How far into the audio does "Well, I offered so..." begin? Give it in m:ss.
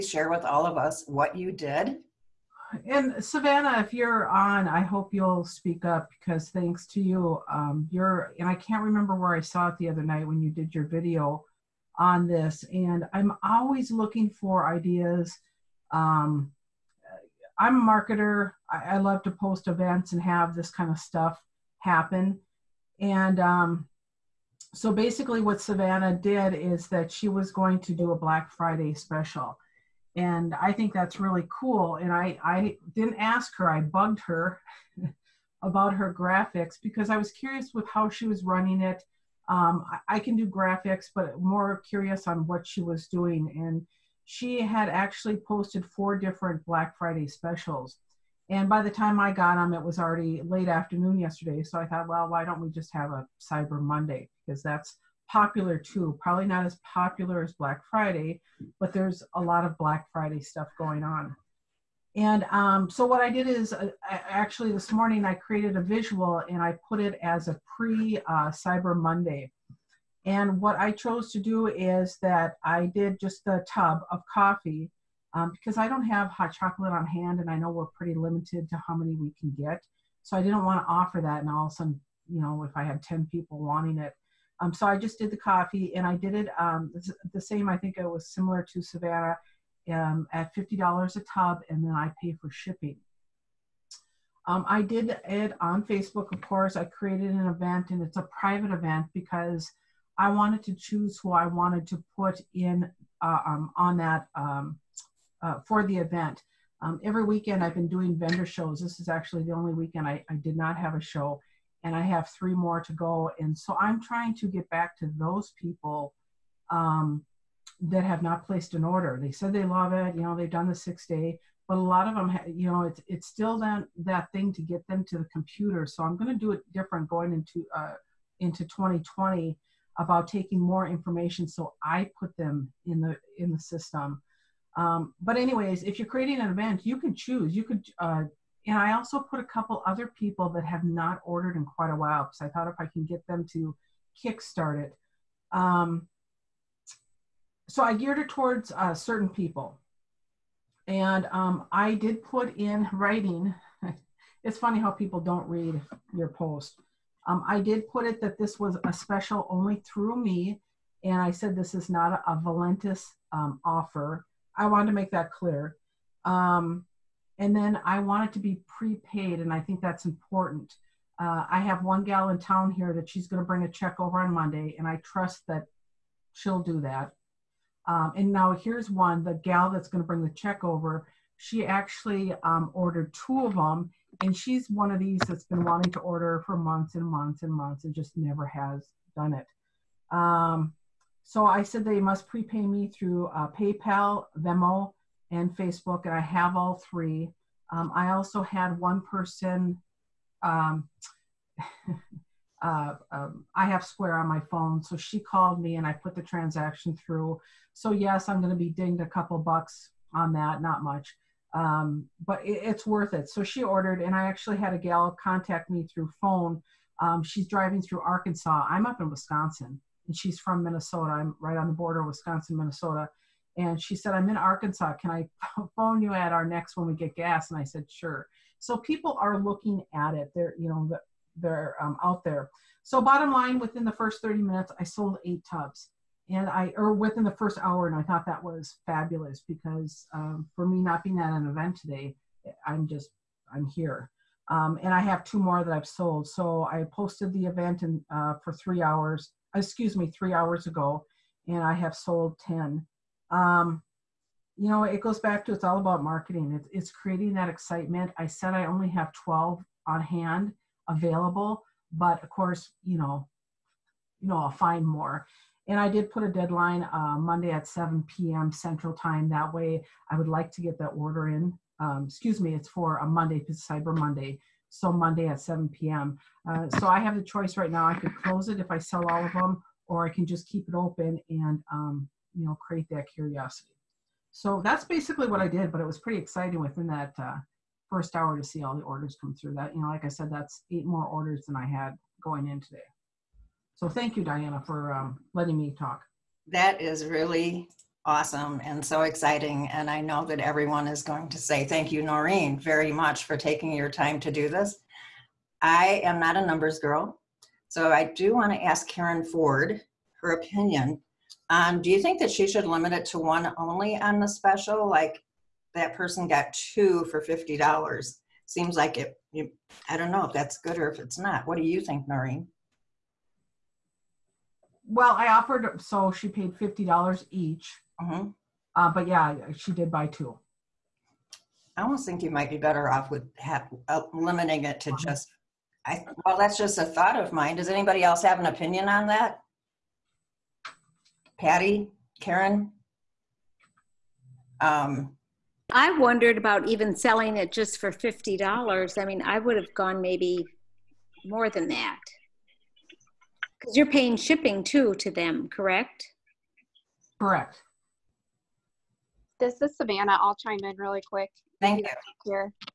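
5:24.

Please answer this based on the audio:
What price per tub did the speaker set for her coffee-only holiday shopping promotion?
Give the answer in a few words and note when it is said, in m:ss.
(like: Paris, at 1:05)
$50, at 1:30.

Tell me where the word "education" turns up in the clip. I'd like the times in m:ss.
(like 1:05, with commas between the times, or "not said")
not said.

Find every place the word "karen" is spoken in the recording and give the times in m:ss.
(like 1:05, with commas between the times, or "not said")
5:08, 5:42.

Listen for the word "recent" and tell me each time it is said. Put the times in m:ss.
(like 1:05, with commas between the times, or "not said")
not said.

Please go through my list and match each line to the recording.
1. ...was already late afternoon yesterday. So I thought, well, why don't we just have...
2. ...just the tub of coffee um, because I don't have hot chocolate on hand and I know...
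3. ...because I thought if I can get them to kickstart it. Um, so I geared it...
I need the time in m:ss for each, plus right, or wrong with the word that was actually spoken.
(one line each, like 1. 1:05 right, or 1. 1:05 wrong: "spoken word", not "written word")
1. 0:49 right
2. 1:13 right
3. 2:22 right.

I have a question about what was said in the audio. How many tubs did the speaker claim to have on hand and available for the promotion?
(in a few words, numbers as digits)
12.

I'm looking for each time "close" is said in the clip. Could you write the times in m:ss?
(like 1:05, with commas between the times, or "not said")
4:38.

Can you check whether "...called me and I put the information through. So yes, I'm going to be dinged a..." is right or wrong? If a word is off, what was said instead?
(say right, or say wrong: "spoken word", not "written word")
wrong: "transaction", not "information".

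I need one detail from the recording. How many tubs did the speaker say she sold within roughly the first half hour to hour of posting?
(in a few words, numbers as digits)
8.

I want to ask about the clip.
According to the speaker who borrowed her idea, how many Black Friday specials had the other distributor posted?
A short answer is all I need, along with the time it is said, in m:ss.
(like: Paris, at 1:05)
4, at 0:45.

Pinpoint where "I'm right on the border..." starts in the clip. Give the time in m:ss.
3:41.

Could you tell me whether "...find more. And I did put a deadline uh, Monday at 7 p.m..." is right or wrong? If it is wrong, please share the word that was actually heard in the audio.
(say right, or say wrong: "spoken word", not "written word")
right.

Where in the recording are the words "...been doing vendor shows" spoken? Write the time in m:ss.
1:47.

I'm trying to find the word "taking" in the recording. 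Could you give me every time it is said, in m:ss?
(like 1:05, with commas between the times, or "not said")
2:10, 5:03.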